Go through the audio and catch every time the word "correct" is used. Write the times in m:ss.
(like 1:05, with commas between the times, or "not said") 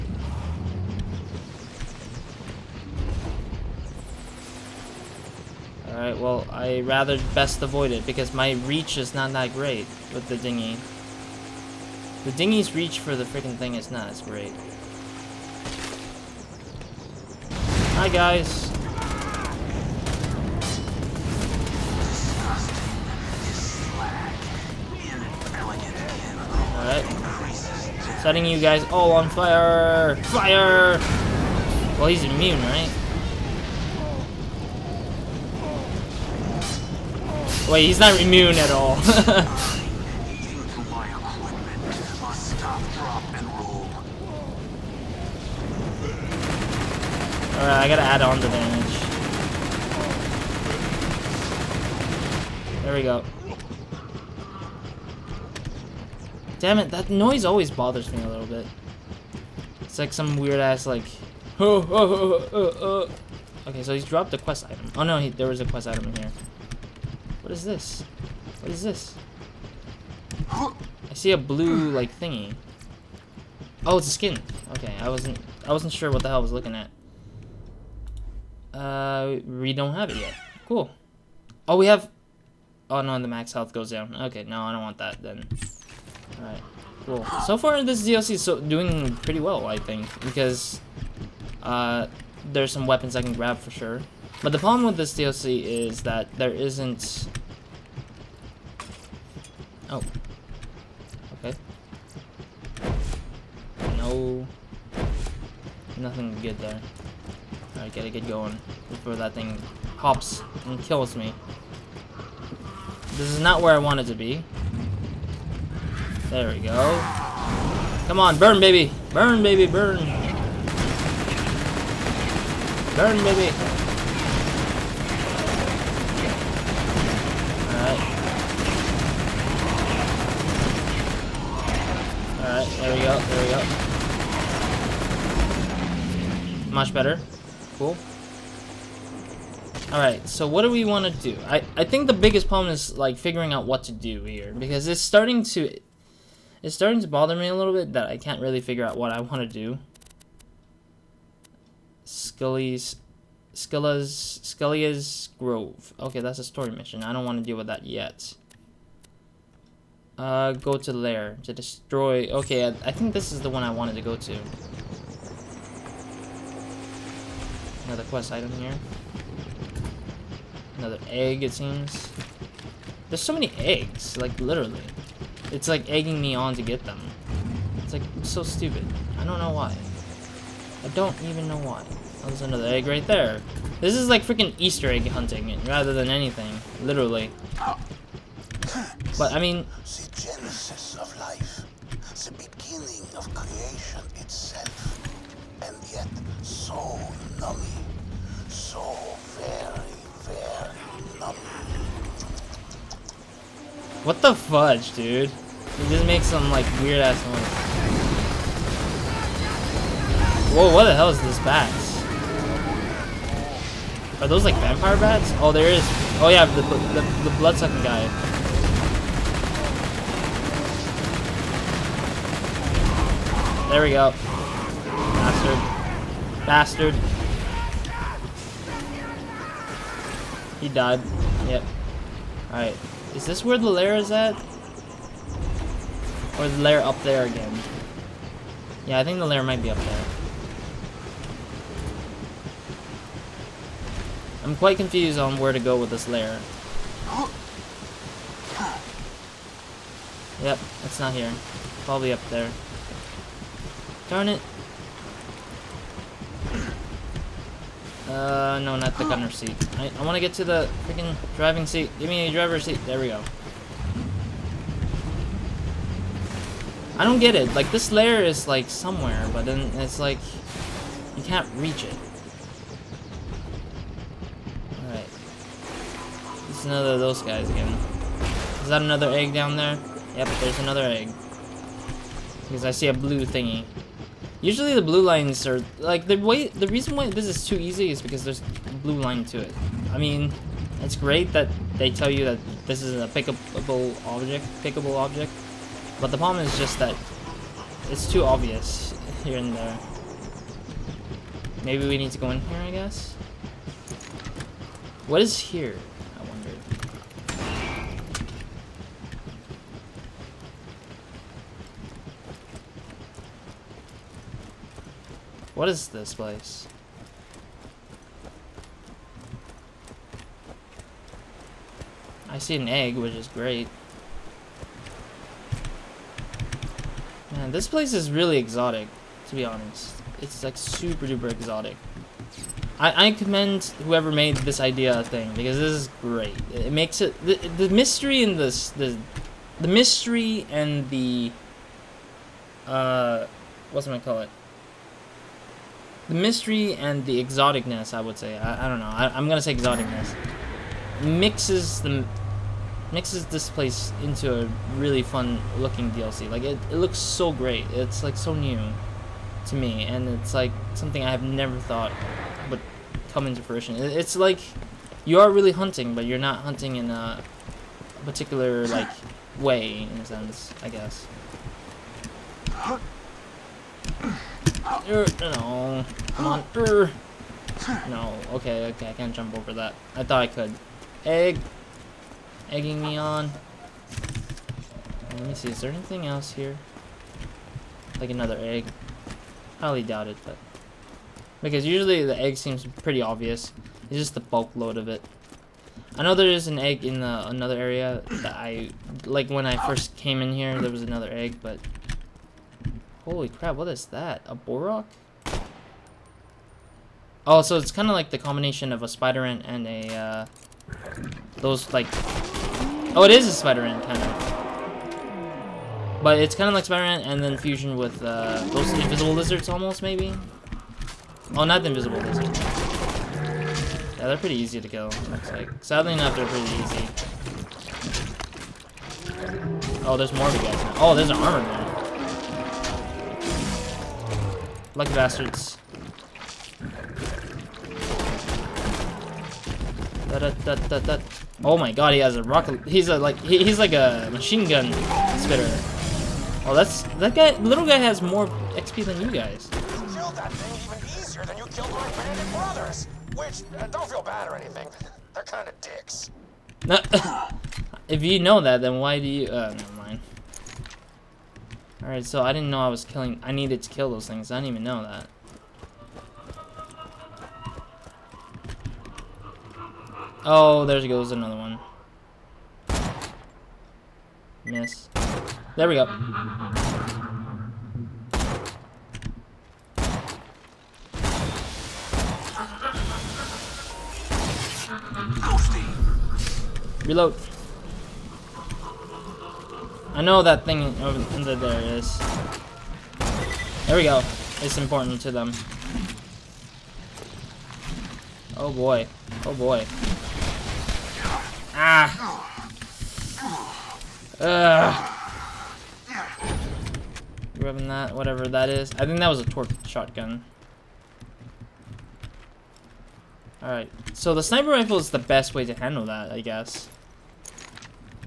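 not said.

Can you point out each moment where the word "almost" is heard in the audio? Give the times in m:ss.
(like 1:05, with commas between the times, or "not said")
6:59.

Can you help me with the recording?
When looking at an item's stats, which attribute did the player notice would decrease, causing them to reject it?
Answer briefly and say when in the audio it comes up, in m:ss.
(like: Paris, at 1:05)
Max health, at 1:23.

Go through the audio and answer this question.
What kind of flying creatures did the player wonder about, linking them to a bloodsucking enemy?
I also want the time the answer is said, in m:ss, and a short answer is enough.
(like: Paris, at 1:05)
Vampire bats, at 3:34.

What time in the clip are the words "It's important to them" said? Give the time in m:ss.
8:14.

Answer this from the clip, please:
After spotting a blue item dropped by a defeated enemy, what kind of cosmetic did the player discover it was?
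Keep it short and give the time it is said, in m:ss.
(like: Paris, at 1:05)
A skin, at 1:13.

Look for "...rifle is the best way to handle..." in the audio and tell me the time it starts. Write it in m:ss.
8:34.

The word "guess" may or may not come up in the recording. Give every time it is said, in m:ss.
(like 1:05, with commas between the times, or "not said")
5:02, 6:10, 8:36.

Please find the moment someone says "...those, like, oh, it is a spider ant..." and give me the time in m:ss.
6:51.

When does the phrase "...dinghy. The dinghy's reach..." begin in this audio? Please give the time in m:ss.
0:10.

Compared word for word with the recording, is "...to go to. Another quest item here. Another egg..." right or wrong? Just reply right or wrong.
right.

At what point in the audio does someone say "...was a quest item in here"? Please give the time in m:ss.
1:05.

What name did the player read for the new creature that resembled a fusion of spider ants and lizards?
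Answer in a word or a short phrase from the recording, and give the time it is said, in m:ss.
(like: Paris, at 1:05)
Borok, at 6:44.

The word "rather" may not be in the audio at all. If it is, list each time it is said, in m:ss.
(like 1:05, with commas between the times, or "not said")
0:06, 3:05.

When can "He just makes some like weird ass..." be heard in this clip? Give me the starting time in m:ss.
3:25.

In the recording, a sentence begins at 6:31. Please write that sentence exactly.
Because usually the egg seems pretty obvious.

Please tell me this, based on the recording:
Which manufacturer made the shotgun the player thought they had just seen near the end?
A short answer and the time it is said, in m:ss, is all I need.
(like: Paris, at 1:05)
Torgue, at 8:29.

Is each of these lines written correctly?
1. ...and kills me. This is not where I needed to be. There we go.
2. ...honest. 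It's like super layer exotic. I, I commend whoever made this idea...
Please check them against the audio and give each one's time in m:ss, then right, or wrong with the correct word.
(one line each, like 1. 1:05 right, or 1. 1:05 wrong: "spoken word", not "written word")
1. 1:50 wrong: "wanted", not "needed"
2. 5:29 wrong: "duper", not "layer".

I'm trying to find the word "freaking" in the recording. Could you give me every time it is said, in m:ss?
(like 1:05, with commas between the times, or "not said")
0:13, 3:04, 4:20.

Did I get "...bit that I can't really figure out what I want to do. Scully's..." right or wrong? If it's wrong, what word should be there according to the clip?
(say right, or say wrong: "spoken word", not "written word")
right.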